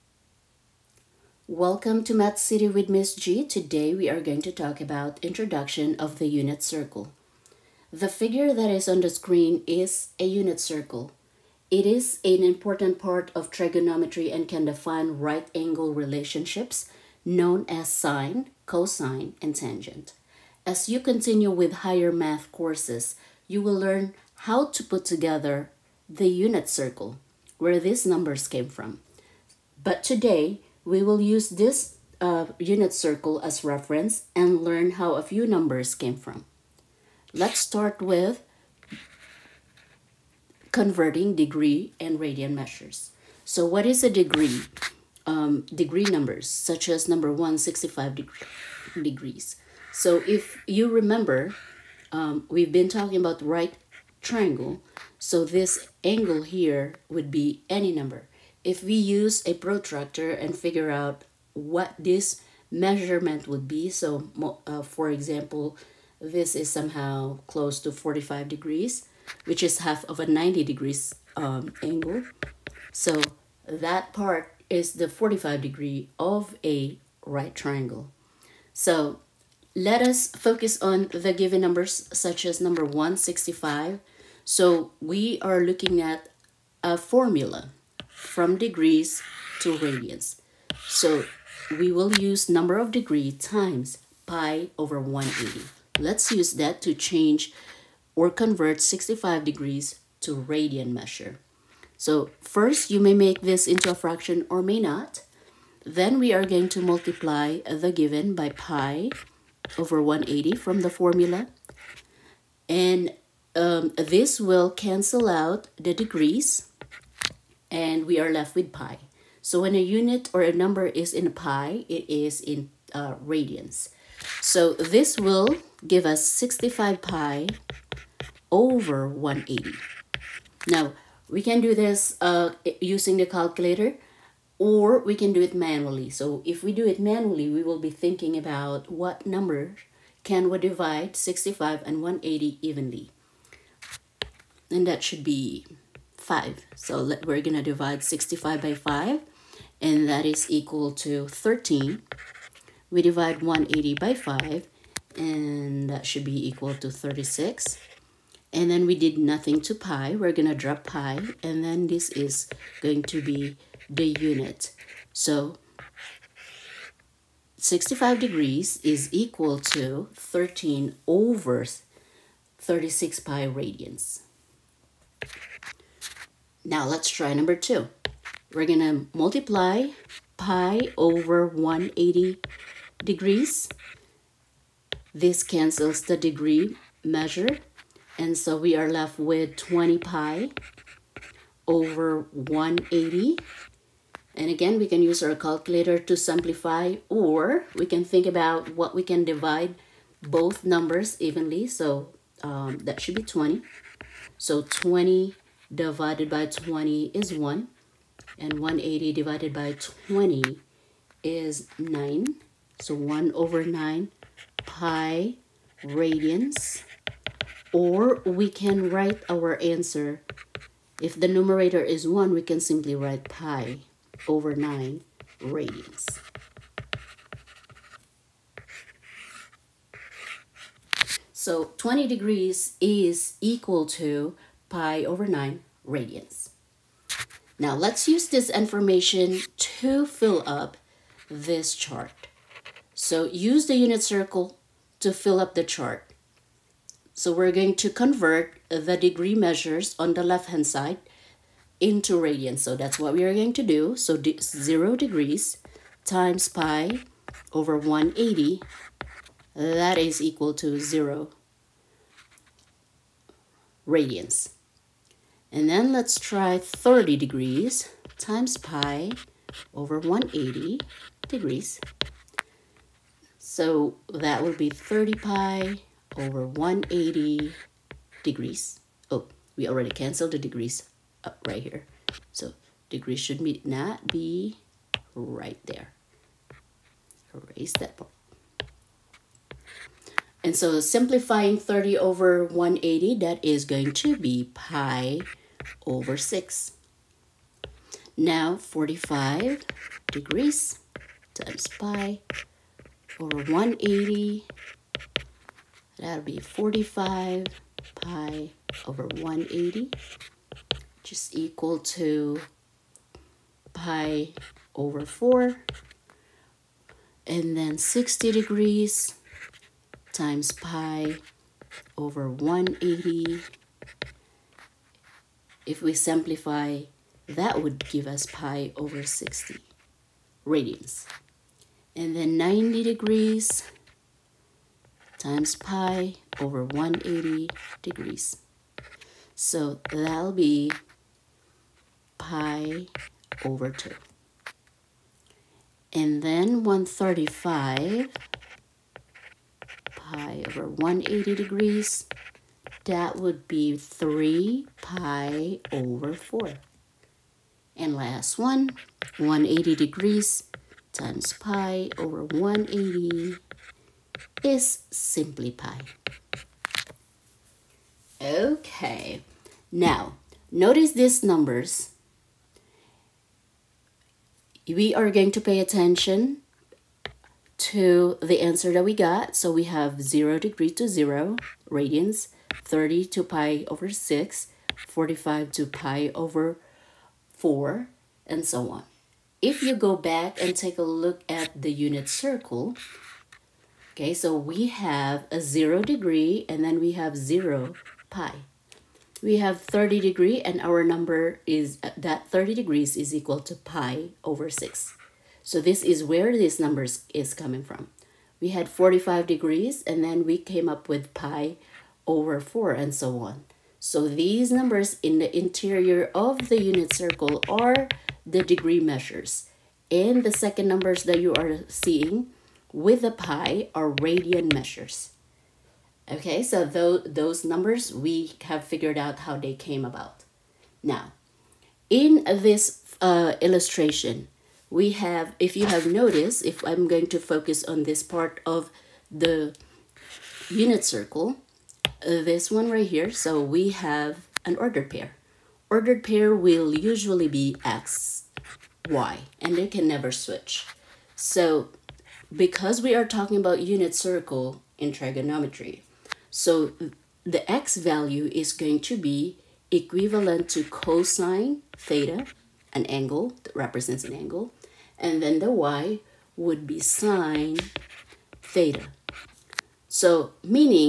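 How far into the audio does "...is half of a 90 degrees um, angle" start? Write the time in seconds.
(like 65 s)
69 s.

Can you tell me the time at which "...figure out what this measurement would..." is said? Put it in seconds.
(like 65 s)
60 s.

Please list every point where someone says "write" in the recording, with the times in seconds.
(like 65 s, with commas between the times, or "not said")
218 s, 222 s.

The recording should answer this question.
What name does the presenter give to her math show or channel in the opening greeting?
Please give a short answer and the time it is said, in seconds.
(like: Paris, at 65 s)
Math City, at 2 s.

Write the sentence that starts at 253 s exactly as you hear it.
So de zero degrees times pi over 180, that is equal to zero radians.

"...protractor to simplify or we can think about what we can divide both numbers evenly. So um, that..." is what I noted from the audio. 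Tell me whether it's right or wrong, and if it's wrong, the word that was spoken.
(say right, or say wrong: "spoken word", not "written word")
wrong: "calculator", not "protractor".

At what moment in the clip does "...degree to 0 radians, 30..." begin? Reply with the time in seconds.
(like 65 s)
380 s.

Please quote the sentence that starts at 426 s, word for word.
Okay, so th those numbers, we have figured out how they came about.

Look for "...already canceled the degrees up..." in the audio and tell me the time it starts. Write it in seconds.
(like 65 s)
279 s.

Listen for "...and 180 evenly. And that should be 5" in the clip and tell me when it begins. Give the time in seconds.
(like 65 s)
141 s.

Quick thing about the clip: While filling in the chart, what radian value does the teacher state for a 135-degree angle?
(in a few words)
3 pi over 4.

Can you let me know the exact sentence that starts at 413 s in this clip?
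So these numbers in the interior of the unit circle are the degree measures.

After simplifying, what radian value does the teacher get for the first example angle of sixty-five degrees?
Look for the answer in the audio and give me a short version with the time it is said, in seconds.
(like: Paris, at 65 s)
13/36 pi radians, at 170 s.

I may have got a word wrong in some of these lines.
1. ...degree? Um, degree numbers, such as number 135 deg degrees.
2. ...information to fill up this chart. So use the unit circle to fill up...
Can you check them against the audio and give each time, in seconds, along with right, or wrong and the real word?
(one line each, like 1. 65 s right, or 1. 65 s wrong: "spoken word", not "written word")
1. 44 s wrong: "165", not "135"
2. 238 s right.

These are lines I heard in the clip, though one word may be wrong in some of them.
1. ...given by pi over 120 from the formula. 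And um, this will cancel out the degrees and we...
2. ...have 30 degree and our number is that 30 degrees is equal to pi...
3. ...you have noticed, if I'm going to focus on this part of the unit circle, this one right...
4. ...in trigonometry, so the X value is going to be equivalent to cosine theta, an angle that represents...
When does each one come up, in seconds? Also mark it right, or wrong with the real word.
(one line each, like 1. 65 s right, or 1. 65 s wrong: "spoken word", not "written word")
1. 107 s wrong: "180", not "120"
2. 399 s right
3. 435 s right
4. 454 s right.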